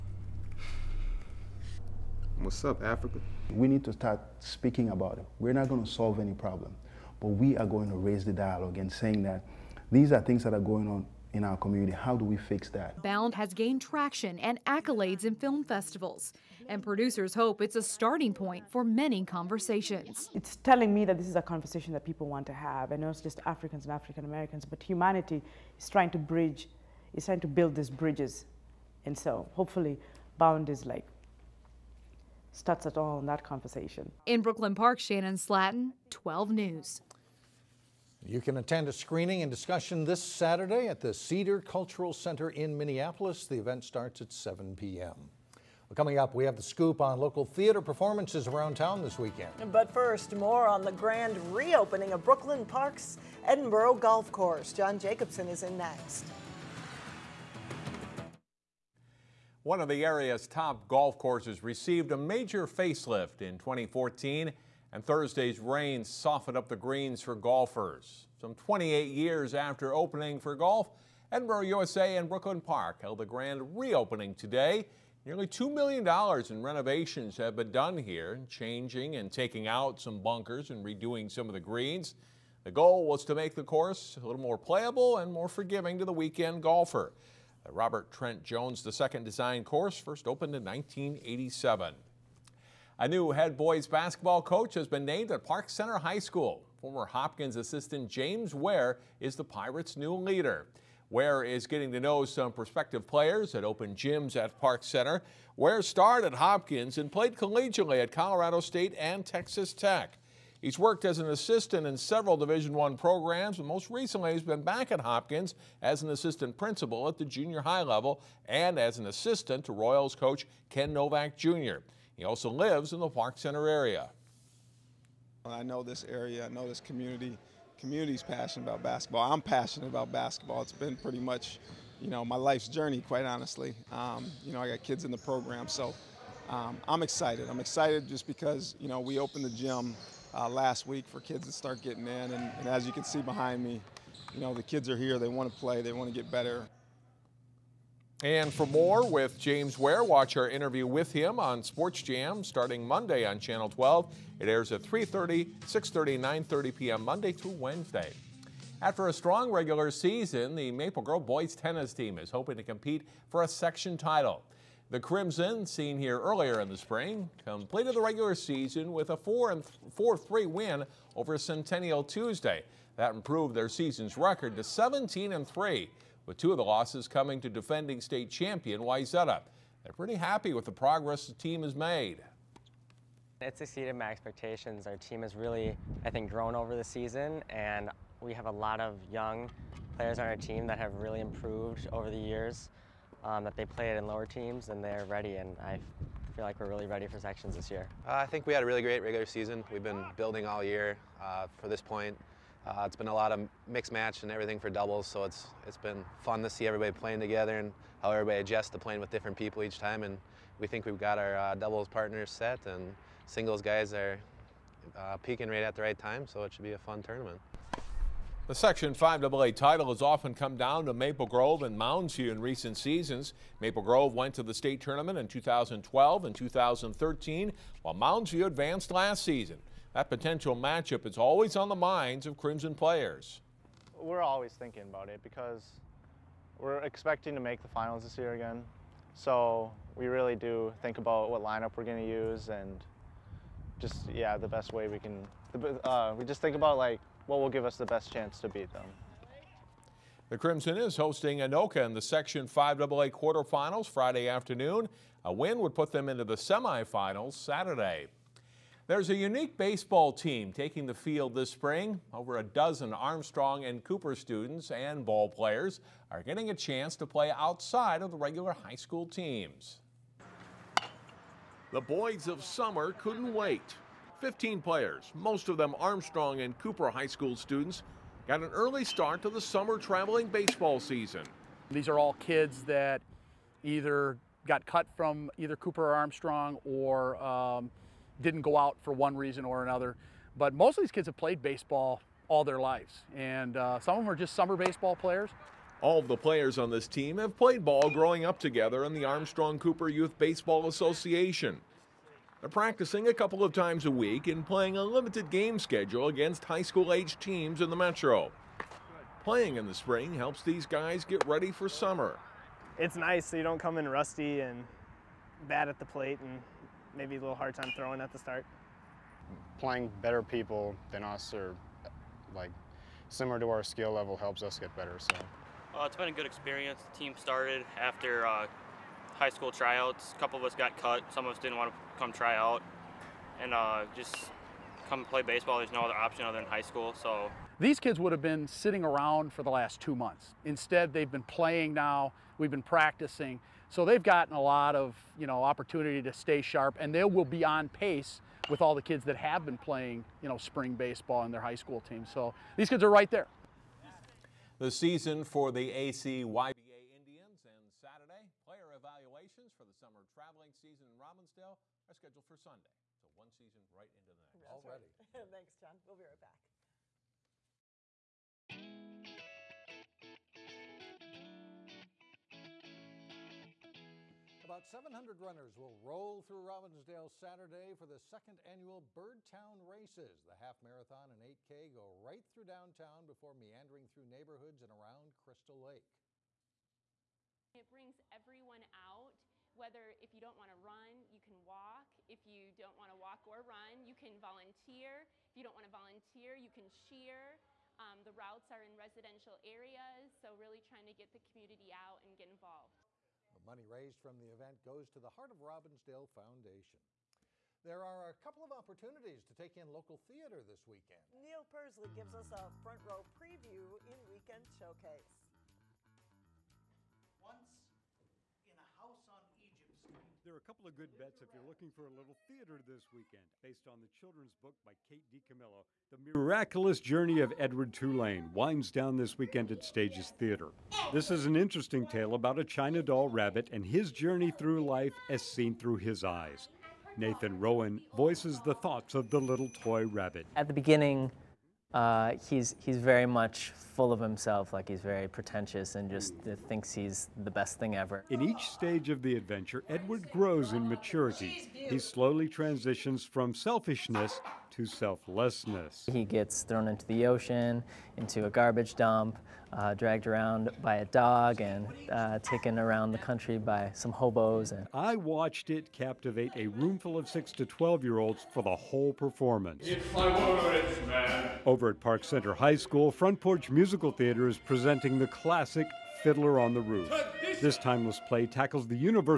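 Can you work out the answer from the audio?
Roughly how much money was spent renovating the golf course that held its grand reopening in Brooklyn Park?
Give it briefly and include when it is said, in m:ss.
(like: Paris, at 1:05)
$2 million, at 1:15.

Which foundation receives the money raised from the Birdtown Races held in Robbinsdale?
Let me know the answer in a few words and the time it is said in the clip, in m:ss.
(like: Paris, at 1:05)
Heart of Robbinsdale Foundation, at 6:45.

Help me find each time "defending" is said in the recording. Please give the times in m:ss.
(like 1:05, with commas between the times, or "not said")
2:57.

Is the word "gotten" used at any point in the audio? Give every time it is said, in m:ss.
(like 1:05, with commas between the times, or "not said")
5:44.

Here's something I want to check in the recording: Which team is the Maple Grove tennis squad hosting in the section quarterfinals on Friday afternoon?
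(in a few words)
Anoka.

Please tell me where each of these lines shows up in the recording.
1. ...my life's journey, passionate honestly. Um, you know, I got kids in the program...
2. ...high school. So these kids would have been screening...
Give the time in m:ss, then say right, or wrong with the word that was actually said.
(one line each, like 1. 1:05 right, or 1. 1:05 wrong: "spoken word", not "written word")
1. 2:12 wrong: "quite", not "passionate"
2. 5:36 wrong: "sitting", not "screening".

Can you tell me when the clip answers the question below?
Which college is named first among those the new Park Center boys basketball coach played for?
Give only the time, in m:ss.
1:48.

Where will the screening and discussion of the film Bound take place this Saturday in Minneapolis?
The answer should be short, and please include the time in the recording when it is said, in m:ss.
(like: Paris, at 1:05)
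Cedar Cultural Center, at 0:41.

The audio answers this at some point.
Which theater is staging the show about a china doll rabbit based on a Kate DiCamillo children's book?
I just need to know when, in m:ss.
7:09.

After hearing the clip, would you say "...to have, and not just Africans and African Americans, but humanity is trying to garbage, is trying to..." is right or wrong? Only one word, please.
wrong.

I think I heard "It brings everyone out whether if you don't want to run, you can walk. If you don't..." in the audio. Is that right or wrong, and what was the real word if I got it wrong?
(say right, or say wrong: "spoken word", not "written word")
right.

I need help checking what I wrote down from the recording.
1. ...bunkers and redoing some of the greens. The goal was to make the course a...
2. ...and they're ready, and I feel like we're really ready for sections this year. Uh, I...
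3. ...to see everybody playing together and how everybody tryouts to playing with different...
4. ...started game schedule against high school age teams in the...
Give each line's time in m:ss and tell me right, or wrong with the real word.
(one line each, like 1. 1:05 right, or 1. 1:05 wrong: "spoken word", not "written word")
1. 1:20 right
2. 3:14 right
3. 3:26 wrong: "adjusts", not "tryouts"
4. 5:04 wrong: "limited", not "started".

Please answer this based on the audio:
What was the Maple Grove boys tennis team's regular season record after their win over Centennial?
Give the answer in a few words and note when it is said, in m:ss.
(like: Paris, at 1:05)
17-3, at 2:54.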